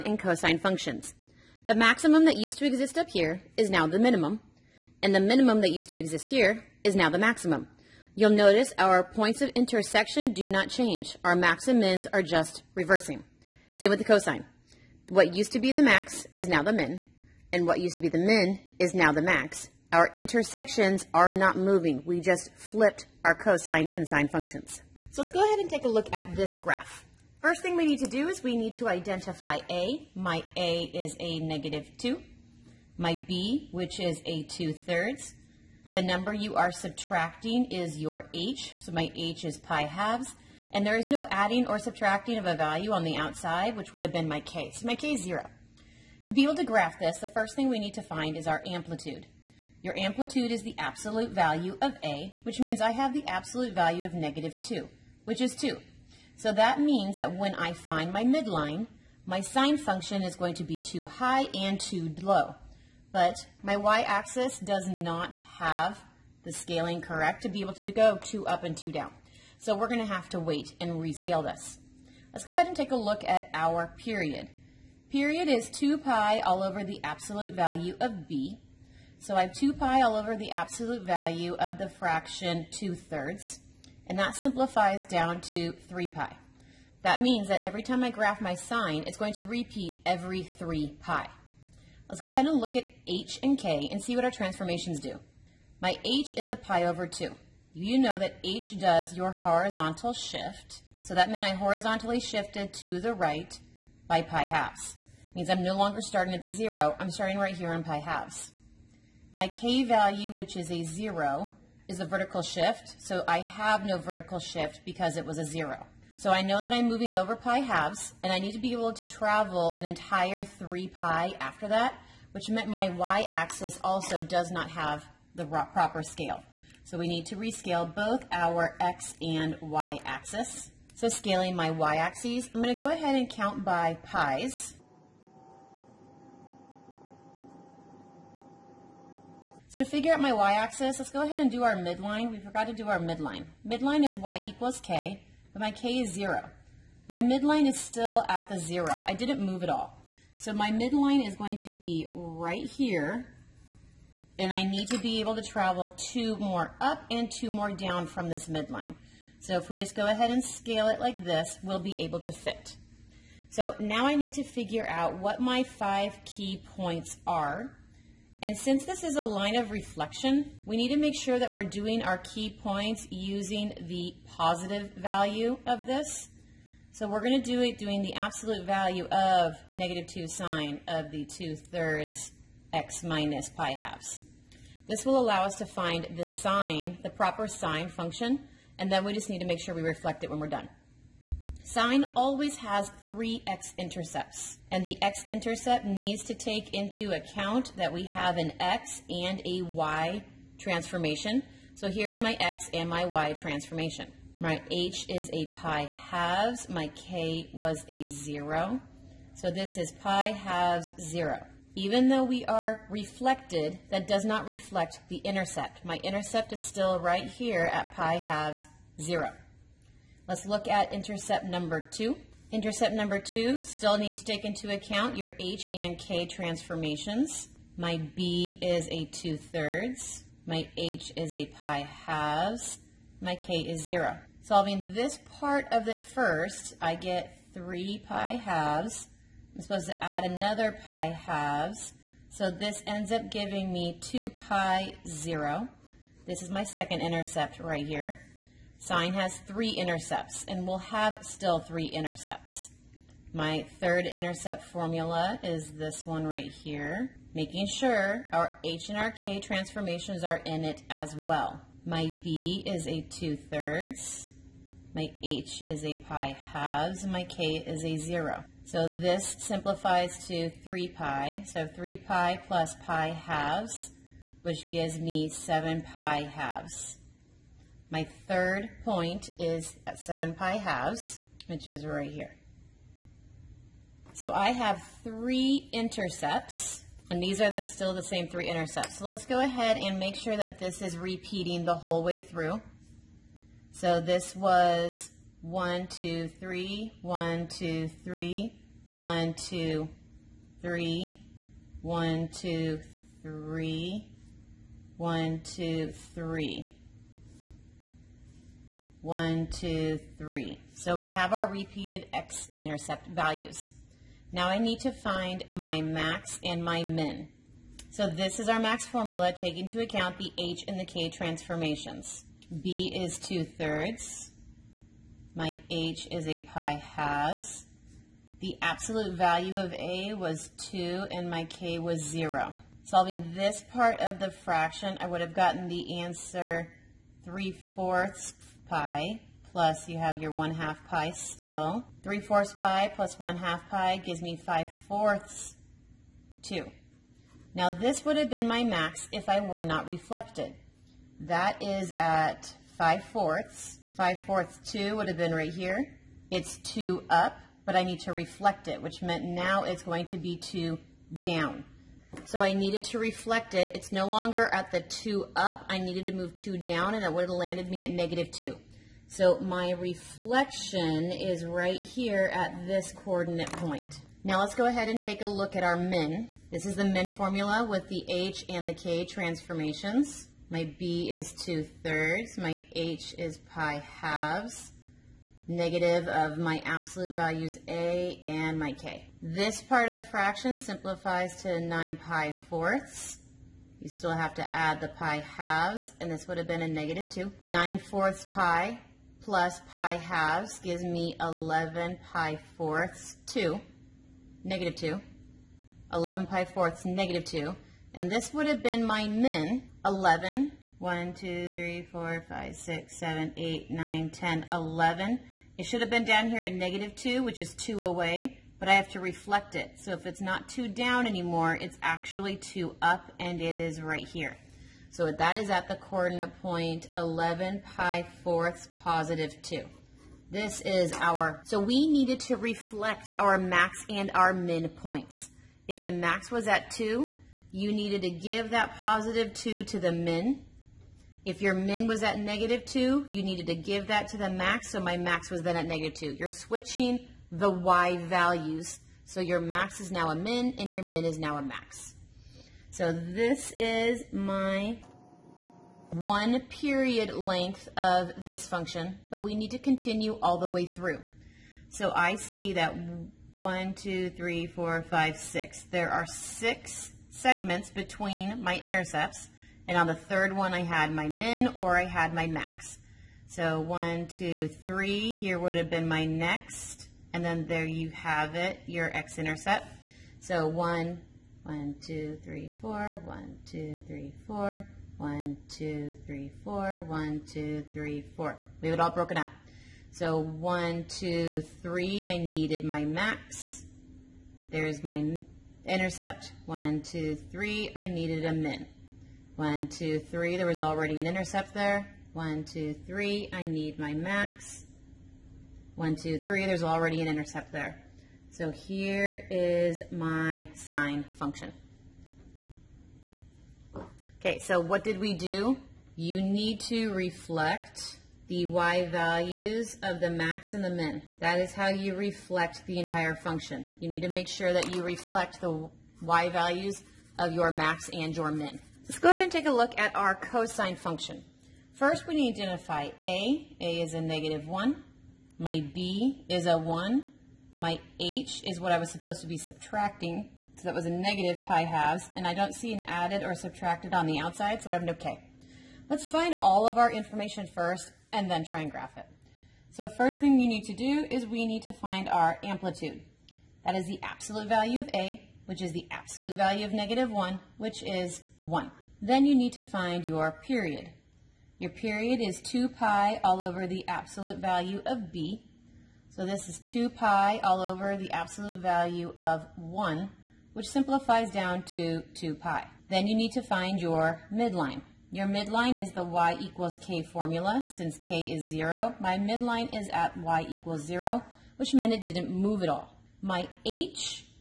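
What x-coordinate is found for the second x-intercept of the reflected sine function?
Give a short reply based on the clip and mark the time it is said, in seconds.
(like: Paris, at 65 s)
2 pi, at 243 s.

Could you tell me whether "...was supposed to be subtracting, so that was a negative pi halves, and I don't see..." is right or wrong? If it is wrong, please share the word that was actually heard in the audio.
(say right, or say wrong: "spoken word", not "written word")
right.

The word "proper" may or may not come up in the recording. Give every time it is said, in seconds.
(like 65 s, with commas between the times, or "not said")
125 s, 187 s.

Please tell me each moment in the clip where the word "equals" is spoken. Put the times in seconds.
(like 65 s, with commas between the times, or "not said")
144 s, 576 s, 580 s.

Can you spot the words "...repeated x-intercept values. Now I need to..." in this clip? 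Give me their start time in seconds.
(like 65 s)
311 s.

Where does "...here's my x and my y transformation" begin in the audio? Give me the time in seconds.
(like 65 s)
201 s.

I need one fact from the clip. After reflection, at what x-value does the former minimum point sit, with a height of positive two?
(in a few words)
11 pi/4.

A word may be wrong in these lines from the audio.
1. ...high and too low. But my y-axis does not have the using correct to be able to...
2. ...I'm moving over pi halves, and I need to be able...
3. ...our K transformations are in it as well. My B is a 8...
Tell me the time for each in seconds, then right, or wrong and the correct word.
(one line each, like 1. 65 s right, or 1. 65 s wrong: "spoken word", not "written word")
1. 61 s wrong: "scaling", not "using"
2. 116 s right
3. 258 s wrong: "2", not "8".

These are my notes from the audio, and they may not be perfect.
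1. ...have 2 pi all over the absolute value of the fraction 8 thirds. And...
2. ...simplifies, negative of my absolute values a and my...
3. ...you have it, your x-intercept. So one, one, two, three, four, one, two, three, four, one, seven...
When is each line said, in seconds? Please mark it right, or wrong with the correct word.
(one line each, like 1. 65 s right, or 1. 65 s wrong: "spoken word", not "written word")
1. 79 s wrong: "2", not "8"
2. 383 s wrong: "halves", not "simplifies"
3. 477 s wrong: "two", not "seven".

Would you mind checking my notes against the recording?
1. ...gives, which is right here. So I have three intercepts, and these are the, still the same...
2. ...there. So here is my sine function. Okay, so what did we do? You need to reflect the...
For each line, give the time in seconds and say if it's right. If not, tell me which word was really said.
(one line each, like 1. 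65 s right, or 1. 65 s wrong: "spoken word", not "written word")
1. 280 s wrong: "halves", not "gives"
2. 507 s right.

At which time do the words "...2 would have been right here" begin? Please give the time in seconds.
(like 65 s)
354 s.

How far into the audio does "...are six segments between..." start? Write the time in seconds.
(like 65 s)
465 s.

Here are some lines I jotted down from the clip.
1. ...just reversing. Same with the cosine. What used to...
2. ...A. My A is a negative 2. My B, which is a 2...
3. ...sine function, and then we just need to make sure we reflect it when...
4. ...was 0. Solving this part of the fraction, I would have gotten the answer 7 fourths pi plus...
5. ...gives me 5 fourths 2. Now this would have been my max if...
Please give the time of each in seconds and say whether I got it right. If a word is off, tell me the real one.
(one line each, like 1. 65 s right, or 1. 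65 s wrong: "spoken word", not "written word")
1. 12 s right
2. 29 s right
3. 187 s right
4. 331 s wrong: "3", not "7"
5. 343 s right.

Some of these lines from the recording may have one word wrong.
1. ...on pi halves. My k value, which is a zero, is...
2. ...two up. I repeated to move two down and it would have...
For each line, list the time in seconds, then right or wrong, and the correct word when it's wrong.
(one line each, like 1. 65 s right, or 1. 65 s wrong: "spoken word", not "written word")
1. 107 s right
2. 364 s wrong: "needed", not "repeated".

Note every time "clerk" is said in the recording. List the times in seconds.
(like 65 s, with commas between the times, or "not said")
not said.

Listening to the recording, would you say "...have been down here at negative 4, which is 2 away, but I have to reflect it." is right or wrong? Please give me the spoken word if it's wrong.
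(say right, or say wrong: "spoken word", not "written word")
wrong: "2", not "4".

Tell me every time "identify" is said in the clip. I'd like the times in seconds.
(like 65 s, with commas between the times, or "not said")
28 s, 532 s.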